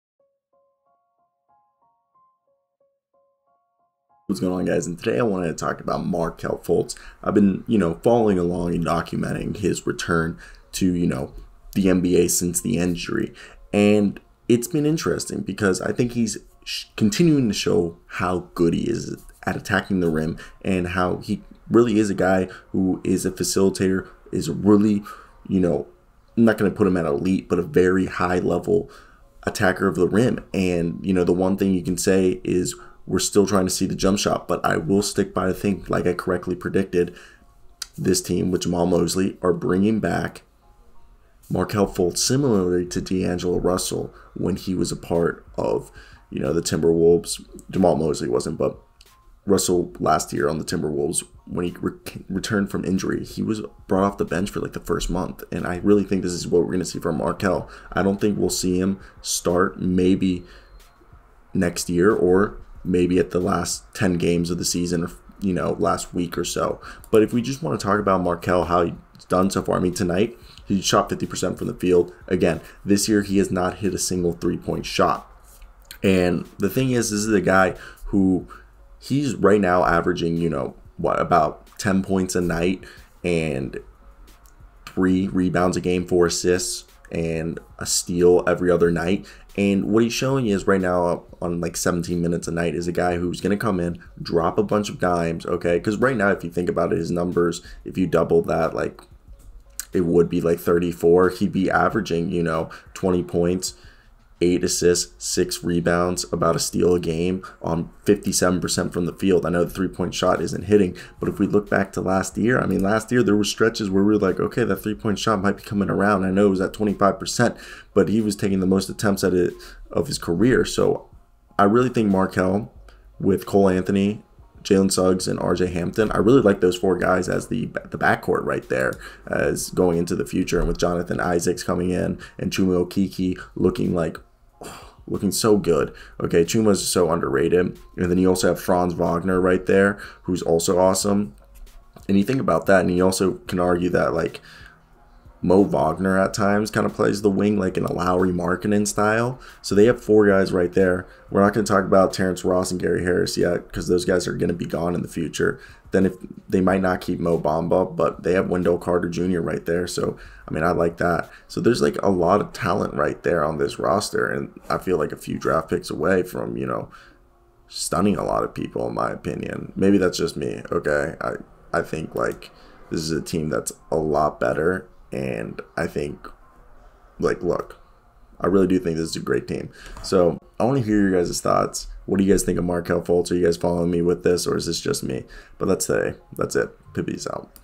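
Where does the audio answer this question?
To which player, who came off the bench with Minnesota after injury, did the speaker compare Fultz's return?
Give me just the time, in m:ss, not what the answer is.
0:43.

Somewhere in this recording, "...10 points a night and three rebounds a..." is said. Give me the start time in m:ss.
1:21.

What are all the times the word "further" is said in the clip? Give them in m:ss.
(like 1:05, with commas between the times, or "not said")
not said.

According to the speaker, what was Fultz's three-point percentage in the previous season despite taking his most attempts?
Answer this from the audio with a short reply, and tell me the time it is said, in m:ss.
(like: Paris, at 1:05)
25%, at 1:56.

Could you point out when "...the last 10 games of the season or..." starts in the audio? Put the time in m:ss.
1:03.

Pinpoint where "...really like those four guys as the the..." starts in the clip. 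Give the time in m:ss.
2:06.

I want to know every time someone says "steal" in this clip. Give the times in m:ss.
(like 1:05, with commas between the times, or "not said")
1:27, 1:46.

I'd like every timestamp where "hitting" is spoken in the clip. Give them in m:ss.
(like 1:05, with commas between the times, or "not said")
1:50.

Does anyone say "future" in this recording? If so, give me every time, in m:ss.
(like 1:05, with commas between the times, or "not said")
2:10, 2:35.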